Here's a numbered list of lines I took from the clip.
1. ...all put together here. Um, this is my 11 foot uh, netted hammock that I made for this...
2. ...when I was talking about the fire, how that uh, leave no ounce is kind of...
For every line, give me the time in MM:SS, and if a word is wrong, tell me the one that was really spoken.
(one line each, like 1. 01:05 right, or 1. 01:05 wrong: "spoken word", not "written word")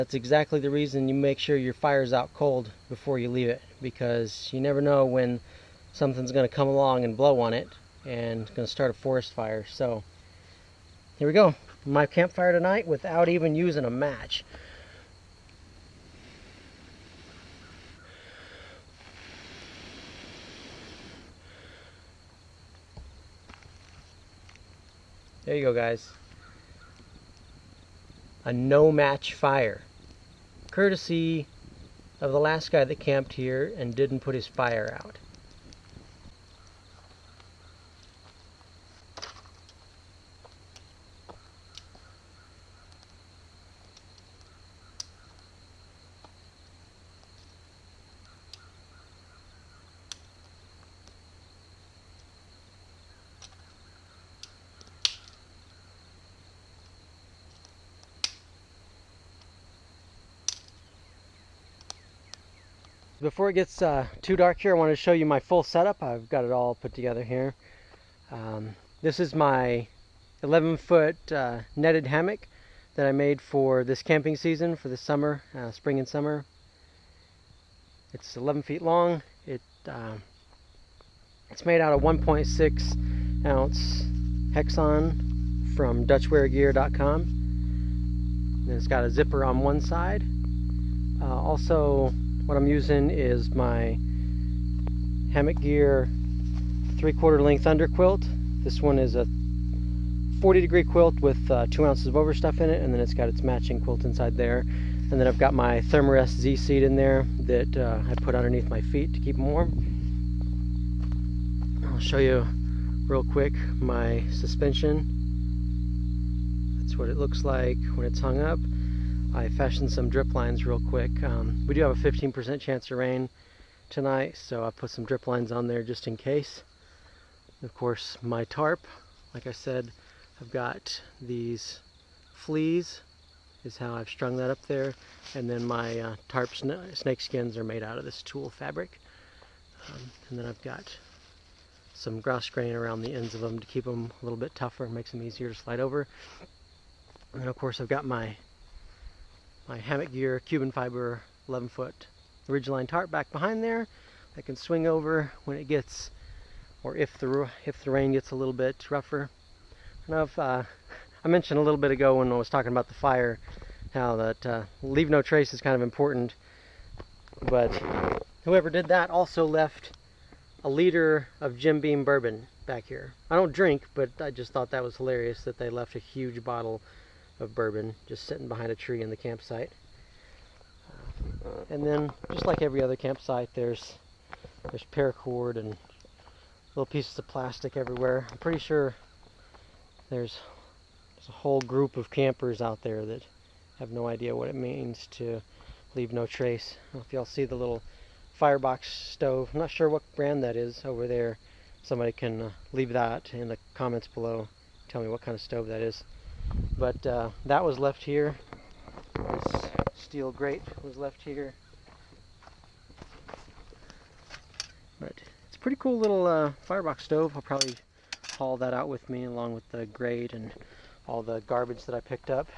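1. 01:06 right
2. 02:42 wrong: "trace", not "ounce".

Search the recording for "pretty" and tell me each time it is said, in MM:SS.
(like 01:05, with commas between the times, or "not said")
03:08, 03:35.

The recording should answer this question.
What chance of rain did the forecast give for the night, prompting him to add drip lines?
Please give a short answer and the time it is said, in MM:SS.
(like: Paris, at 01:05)
15%, at 02:01.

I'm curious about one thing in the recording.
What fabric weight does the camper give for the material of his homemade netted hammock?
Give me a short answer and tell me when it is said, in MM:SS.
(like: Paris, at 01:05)
1.6 ounce, at 01:22.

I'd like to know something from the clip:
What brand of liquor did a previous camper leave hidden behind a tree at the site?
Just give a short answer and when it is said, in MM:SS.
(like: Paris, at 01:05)
Jim Beam, at 02:51.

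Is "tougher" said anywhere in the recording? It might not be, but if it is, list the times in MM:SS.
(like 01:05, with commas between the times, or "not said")
02:24.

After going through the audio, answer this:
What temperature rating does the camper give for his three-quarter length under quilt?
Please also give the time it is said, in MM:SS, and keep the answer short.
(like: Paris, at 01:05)
40 degree, at 01:40.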